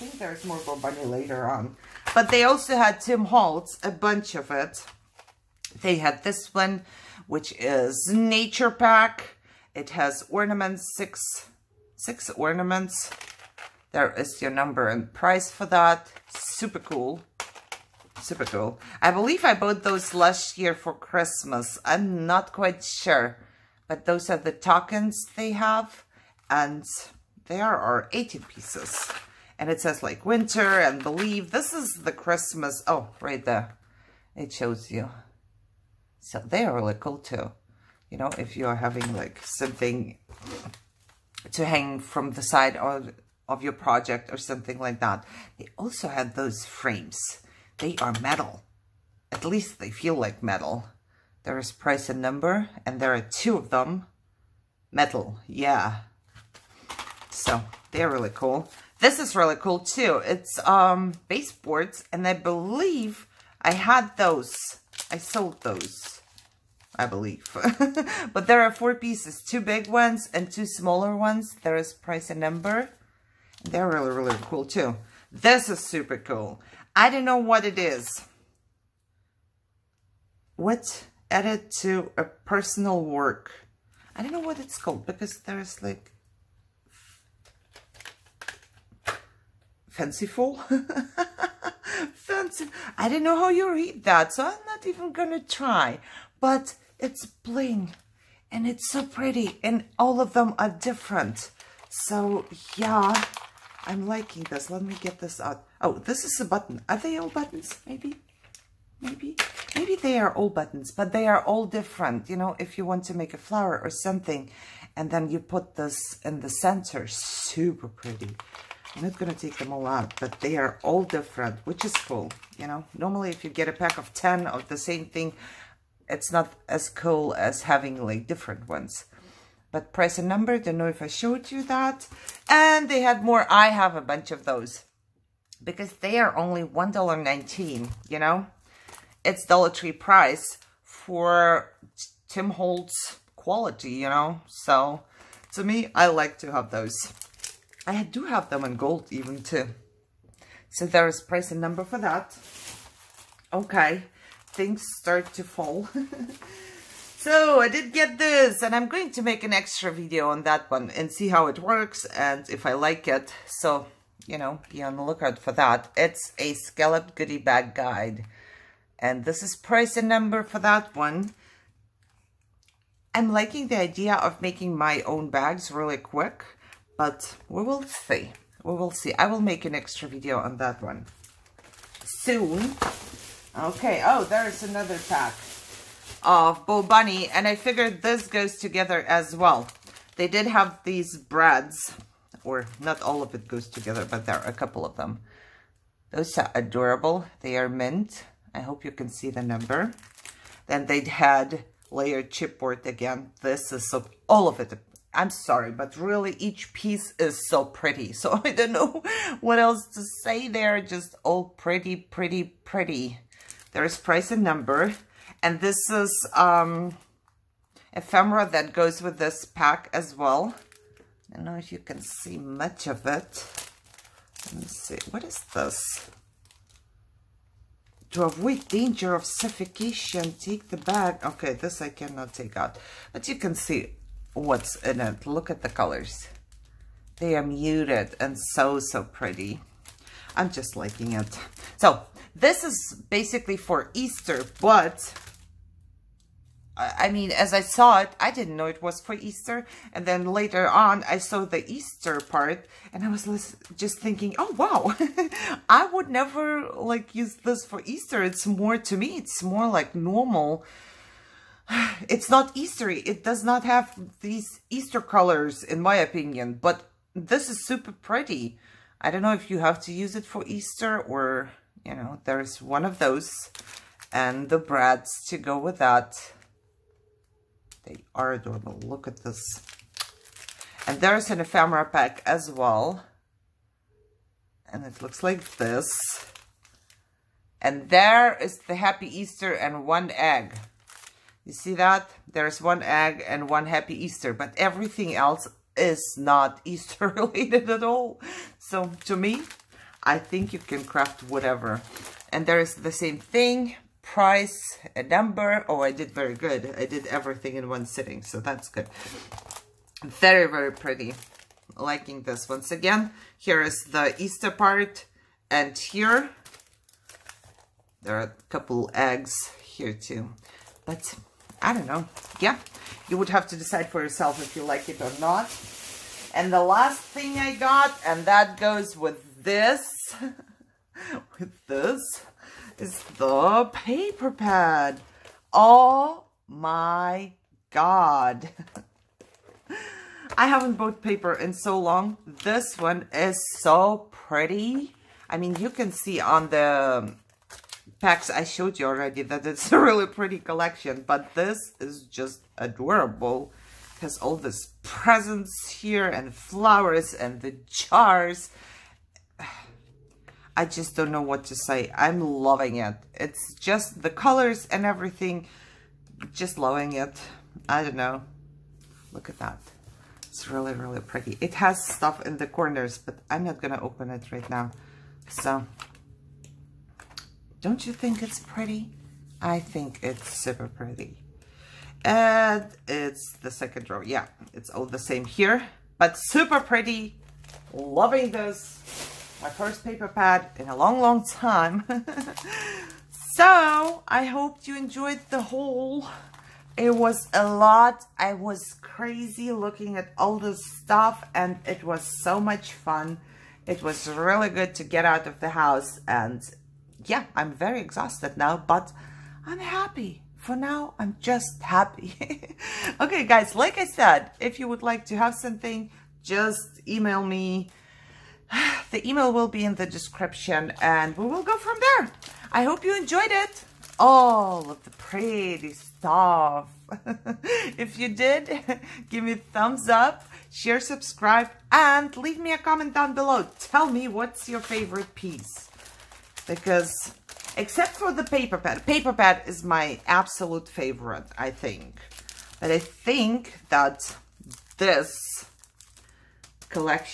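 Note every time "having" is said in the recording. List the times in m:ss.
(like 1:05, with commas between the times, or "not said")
0:38, 2:07.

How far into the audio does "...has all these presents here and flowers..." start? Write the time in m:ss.
5:54.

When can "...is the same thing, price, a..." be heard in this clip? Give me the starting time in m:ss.
5:02.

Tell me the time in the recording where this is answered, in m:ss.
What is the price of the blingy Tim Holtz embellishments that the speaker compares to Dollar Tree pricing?
2:16.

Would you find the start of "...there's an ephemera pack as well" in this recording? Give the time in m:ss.
4:41.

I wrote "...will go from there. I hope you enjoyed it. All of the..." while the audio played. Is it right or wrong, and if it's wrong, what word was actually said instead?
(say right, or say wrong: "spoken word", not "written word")
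right.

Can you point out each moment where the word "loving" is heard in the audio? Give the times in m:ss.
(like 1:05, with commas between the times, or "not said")
6:02, 6:06, 6:27.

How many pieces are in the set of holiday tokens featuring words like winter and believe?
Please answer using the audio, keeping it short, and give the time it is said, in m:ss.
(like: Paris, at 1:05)
18, at 0:28.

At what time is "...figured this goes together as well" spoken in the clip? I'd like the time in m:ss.
3:07.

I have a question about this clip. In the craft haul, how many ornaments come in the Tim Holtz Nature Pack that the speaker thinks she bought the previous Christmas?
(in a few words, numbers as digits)
6.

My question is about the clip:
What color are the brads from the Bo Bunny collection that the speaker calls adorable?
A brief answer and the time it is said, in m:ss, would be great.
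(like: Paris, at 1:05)
mint, at 3:17.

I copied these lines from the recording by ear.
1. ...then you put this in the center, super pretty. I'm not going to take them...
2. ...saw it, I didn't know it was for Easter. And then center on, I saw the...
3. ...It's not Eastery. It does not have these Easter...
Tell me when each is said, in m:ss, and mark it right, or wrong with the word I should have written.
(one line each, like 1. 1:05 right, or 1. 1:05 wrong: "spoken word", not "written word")
1. 1:55 right
2. 4:07 wrong: "later", not "center"
3. 4:22 right.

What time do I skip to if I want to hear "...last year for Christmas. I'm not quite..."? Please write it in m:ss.
0:20.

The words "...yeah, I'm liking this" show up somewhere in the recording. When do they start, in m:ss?
1:42.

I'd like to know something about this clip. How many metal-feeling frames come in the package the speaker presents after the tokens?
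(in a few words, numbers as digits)
2.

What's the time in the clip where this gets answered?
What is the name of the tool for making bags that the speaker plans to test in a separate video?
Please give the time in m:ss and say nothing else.
2:46.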